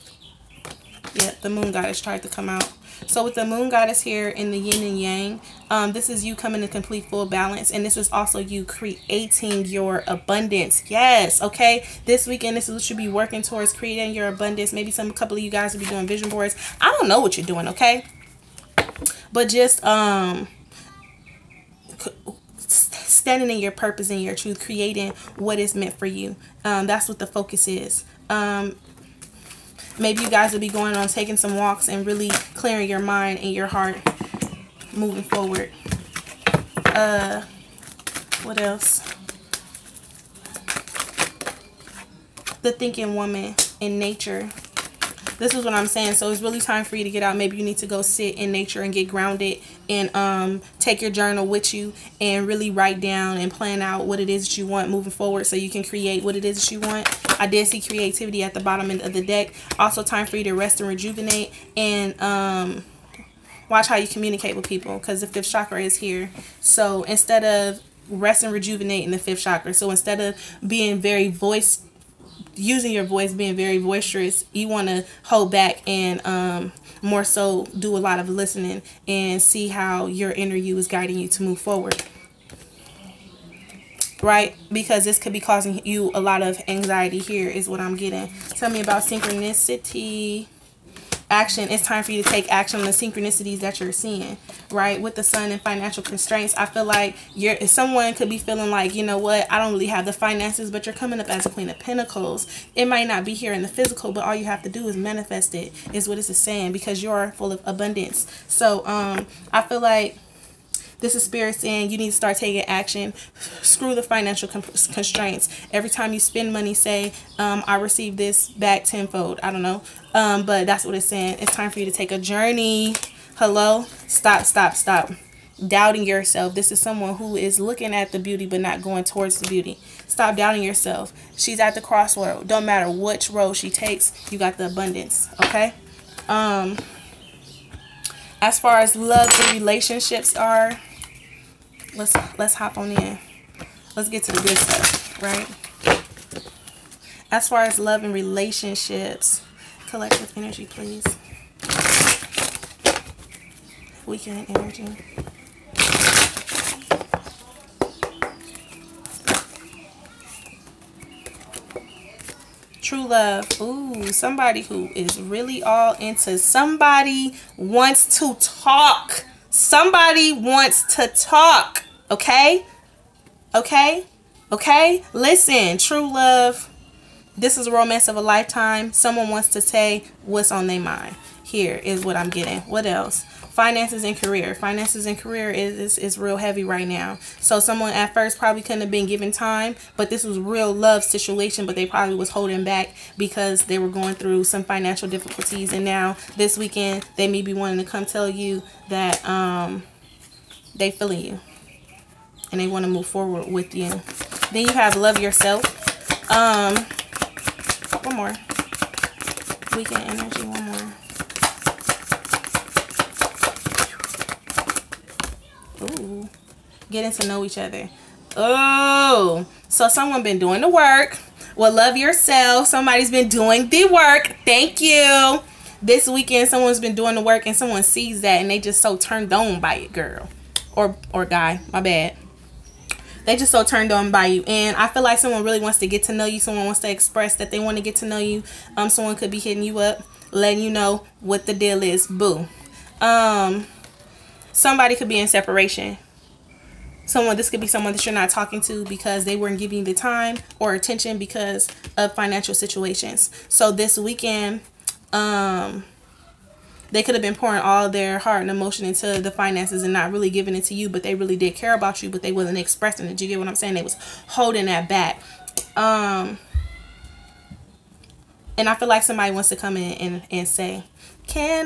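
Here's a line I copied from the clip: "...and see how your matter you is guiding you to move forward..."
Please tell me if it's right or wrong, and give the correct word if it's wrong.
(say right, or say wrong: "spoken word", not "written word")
wrong: "inner", not "matter".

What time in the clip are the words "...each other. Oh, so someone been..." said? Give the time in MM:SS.
03:37.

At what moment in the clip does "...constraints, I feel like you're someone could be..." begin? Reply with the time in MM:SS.
01:36.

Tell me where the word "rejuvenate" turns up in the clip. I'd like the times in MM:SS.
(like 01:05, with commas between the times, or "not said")
01:00, 01:08.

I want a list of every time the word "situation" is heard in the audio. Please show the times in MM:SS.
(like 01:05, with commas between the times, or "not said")
03:11, 04:12.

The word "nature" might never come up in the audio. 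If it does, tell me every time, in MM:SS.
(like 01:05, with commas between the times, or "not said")
00:43, 00:48.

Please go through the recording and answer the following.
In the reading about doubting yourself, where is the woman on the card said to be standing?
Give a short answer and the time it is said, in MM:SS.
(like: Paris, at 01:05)
at the crossroad, at 02:11.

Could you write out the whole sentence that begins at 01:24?
Because this could be causing you a lot of anxiety here is what I'm getting.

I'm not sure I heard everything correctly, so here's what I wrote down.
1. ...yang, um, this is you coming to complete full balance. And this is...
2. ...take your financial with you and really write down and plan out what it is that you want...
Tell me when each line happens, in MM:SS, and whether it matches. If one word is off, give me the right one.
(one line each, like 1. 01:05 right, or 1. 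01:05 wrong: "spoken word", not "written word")
1. 00:04 right
2. 00:50 wrong: "journal", not "financial".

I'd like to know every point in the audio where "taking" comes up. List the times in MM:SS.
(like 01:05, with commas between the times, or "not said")
00:31, 01:52.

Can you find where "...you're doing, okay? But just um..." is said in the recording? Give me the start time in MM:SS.
00:17.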